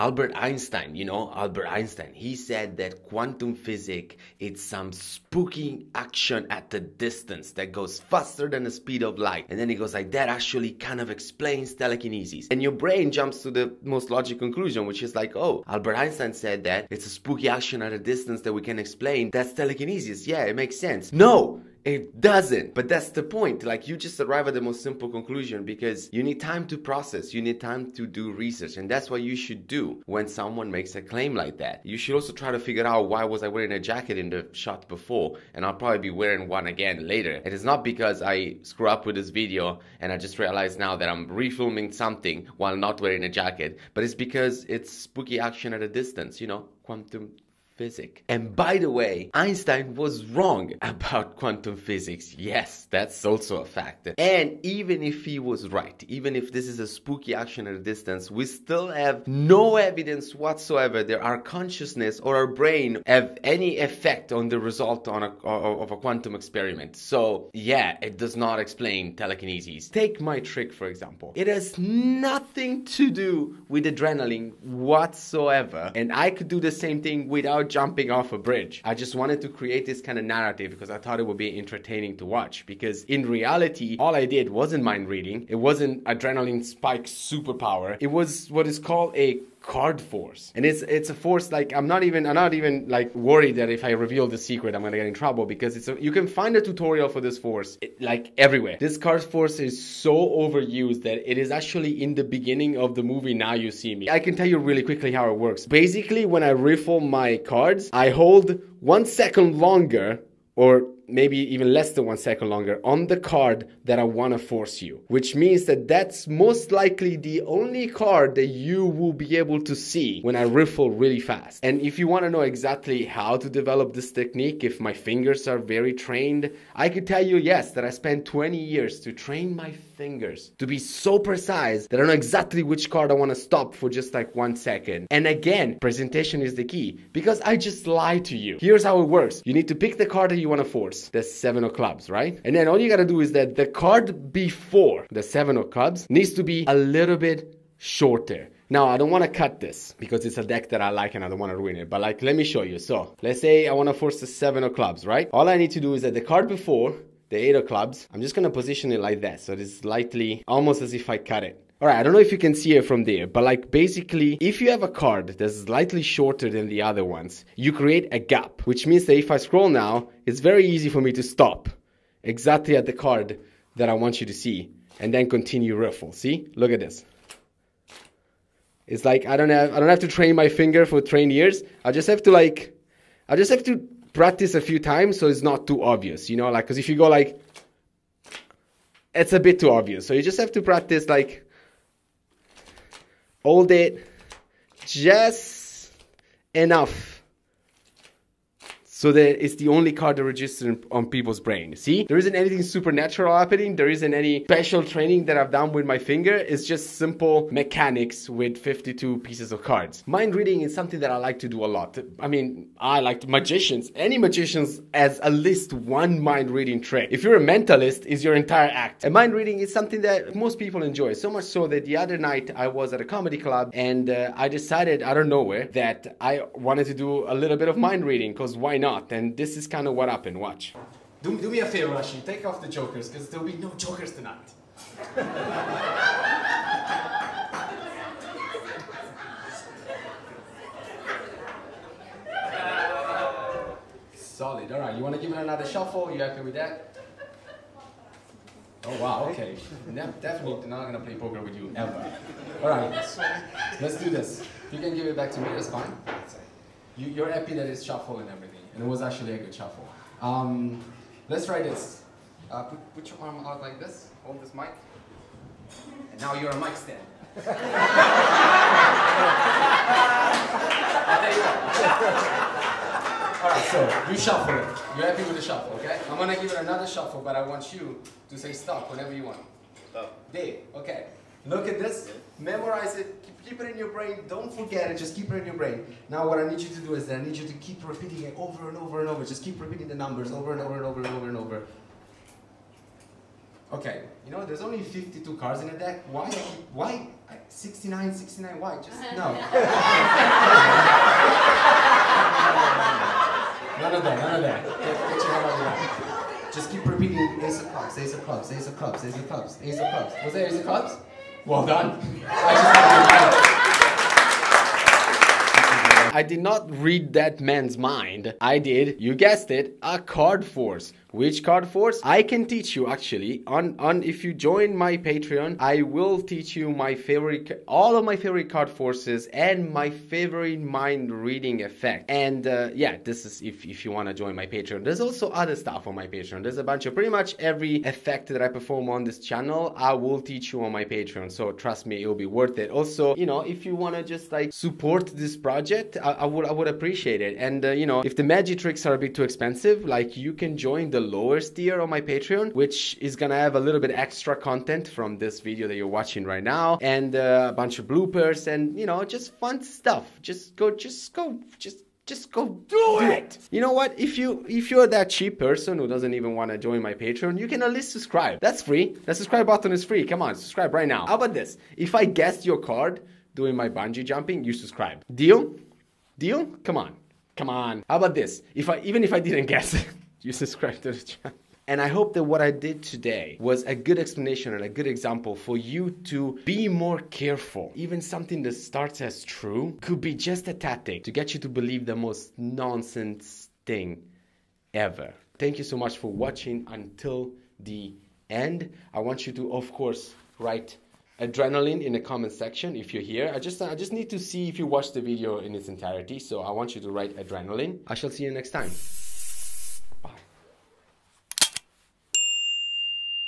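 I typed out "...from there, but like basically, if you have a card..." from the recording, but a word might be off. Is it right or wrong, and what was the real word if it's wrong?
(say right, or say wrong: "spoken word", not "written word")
right.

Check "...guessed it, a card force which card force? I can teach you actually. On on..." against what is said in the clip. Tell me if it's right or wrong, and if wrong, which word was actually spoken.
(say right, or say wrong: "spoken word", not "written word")
right.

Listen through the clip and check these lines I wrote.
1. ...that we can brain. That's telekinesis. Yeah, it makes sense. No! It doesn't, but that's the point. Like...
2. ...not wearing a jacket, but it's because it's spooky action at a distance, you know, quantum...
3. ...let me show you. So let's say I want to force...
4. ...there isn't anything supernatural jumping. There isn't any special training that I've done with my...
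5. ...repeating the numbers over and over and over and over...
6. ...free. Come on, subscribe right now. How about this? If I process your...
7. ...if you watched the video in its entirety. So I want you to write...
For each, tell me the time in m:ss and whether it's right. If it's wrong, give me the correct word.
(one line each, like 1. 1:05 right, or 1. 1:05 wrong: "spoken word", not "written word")
1. 0:18 wrong: "explain", not "brain"
2. 0:42 right
3. 2:32 right
4. 3:22 wrong: "happening", not "jumping"
5. 4:49 right
6. 6:09 wrong: "guess", not "process"
7. 6:44 right.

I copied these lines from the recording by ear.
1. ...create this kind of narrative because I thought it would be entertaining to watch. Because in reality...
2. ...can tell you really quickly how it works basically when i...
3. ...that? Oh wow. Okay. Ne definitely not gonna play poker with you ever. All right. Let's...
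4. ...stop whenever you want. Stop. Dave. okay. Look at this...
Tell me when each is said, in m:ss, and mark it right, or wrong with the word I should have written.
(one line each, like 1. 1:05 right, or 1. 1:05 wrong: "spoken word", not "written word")
1. 1:19 right
2. 1:44 right
3. 4:06 right
4. 4:38 right.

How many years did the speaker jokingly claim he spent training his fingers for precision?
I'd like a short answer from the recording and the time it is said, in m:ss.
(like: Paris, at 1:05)
20, at 2:08.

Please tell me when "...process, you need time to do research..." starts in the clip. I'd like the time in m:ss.
0:26.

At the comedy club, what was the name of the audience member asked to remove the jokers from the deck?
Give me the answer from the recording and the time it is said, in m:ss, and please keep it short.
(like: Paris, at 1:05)
Rashi, at 3:51.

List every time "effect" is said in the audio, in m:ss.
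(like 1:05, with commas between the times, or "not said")
1:03, 5:31, 5:37.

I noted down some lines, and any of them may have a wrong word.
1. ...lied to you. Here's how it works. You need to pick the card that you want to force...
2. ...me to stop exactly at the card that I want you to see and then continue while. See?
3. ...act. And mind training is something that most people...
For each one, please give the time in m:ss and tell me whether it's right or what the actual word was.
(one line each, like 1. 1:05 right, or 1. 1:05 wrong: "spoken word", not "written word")
1. 2:17 right
2. 2:51 wrong: "riffle", not "while"
3. 3:38 wrong: "reading", not "training".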